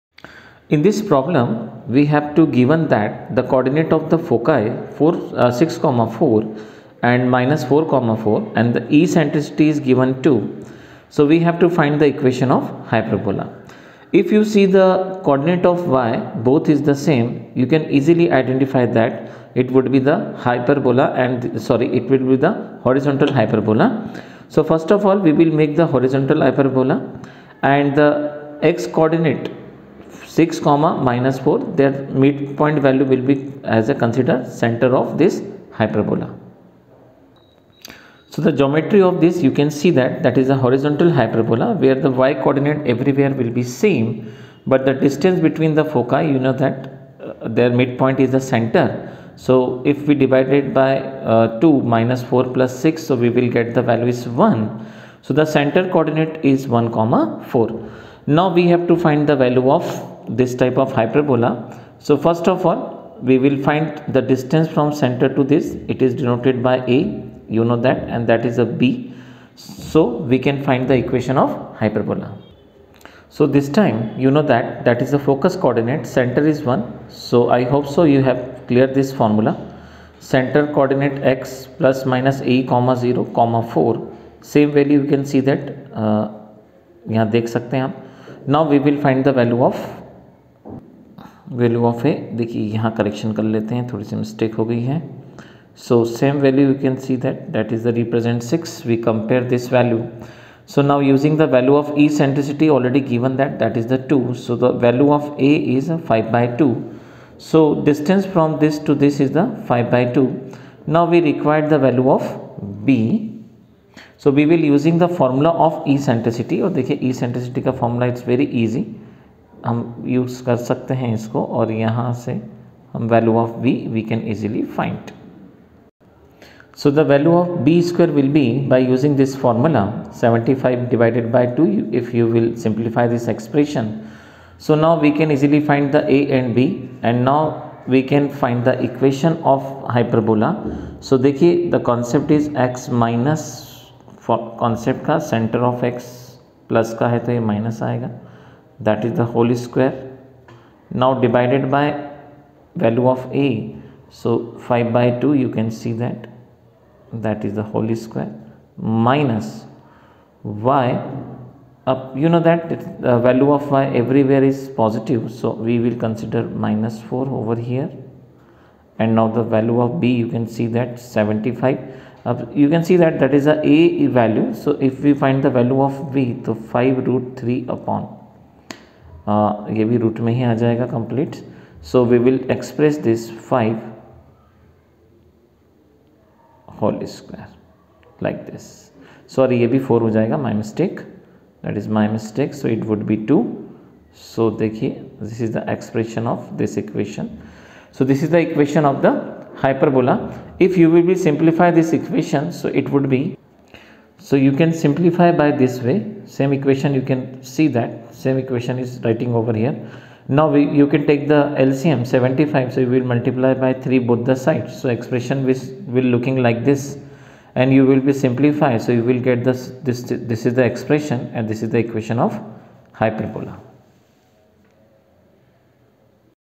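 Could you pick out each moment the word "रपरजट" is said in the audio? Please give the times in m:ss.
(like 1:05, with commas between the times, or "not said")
1:37.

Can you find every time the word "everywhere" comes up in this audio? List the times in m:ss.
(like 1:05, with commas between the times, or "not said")
0:42, 2:43.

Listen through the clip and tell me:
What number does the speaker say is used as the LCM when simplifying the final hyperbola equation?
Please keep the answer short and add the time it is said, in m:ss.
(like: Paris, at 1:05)
75, at 3:31.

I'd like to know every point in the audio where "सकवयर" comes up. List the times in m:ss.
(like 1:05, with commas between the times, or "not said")
2:07, 2:29, 2:38, 3:07.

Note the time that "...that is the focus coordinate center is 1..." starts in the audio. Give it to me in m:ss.
1:14.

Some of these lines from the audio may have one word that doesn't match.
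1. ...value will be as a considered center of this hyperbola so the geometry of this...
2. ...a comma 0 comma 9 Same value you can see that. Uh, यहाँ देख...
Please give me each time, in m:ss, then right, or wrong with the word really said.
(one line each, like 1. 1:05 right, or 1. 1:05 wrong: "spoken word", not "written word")
1. 0:32 right
2. 1:22 wrong: "4", not "9".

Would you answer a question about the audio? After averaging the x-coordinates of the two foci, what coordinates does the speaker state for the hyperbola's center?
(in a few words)
(1, 4).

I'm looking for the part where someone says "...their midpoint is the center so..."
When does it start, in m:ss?
0:47.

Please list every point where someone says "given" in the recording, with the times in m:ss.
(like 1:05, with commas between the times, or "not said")
0:02, 0:09.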